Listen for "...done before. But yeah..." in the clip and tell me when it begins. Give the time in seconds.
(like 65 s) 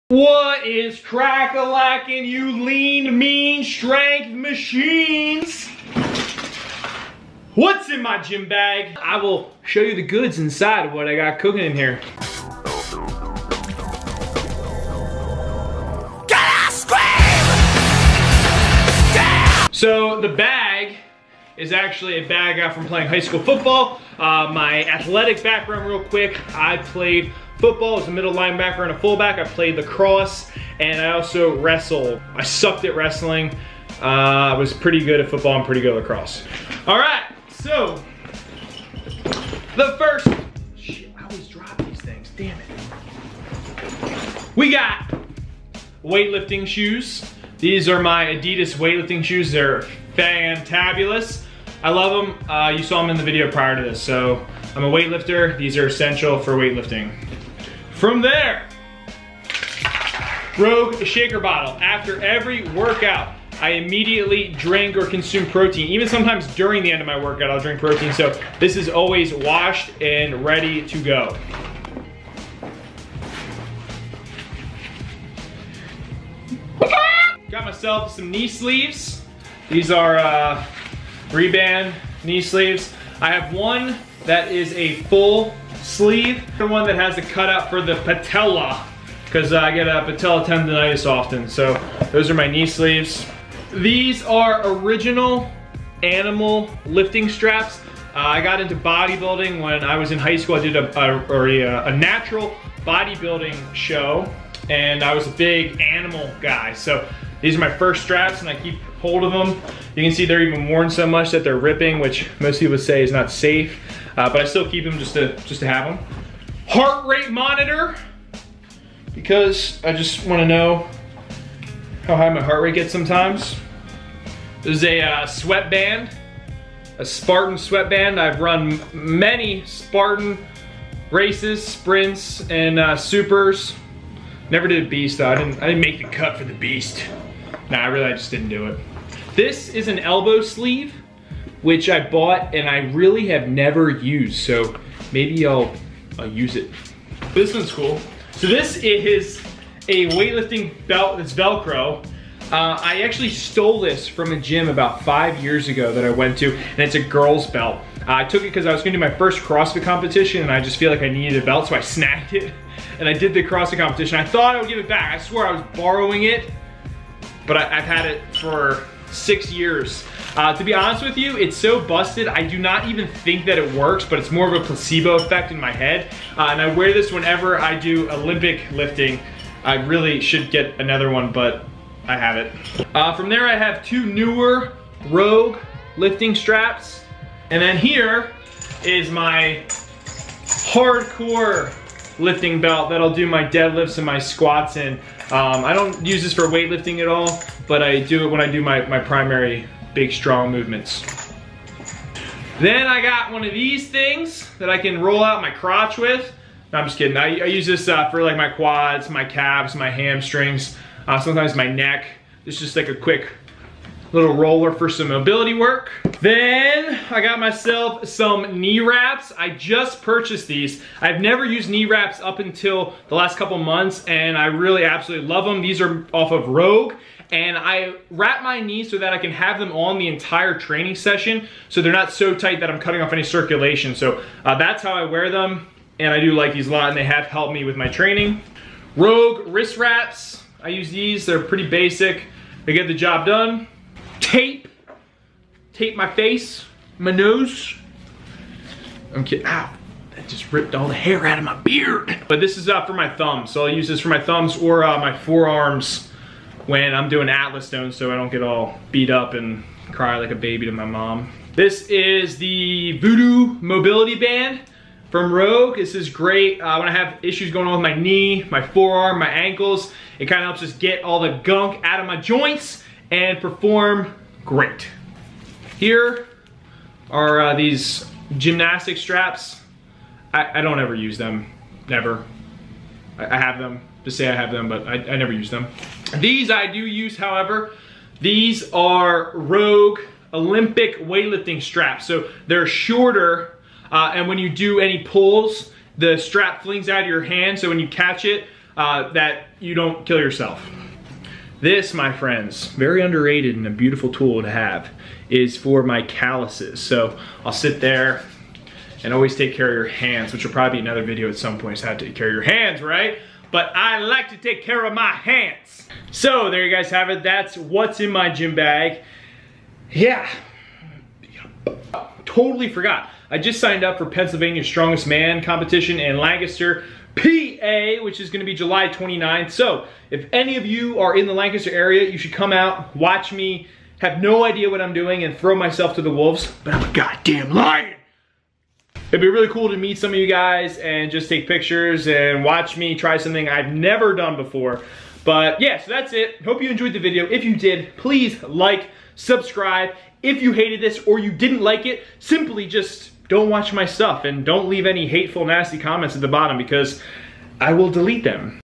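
344 s.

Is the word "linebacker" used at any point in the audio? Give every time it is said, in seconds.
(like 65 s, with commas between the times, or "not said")
28 s.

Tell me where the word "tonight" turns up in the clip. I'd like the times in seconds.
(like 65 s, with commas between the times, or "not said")
not said.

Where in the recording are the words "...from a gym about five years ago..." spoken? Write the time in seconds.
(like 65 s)
154 s.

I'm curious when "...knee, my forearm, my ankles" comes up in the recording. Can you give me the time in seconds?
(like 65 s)
267 s.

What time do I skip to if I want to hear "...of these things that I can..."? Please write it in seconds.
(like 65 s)
203 s.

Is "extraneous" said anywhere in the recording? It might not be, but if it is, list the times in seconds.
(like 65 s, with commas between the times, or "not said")
not said.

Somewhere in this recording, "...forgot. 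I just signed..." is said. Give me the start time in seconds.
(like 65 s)
322 s.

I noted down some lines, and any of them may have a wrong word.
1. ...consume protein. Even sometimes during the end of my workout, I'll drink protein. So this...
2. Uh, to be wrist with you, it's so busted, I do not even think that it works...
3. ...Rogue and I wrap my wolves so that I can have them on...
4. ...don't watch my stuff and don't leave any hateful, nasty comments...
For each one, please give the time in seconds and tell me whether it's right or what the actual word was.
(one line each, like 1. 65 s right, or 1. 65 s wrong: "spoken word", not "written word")
1. 65 s right
2. 170 s wrong: "honest", not "wrist"
3. 226 s wrong: "knees", not "wolves"
4. 353 s right.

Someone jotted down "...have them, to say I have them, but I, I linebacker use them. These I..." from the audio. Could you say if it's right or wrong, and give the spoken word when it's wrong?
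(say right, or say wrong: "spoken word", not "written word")
wrong: "never", not "linebacker".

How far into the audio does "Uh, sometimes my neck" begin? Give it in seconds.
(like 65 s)
211 s.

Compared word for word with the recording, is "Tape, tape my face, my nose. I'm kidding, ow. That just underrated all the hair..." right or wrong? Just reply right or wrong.
wrong.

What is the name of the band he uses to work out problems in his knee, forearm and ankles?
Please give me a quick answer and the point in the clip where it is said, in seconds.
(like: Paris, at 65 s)
Voodoo Mobility Band, at 262 s.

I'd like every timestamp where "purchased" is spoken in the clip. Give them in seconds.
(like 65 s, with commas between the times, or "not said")
220 s.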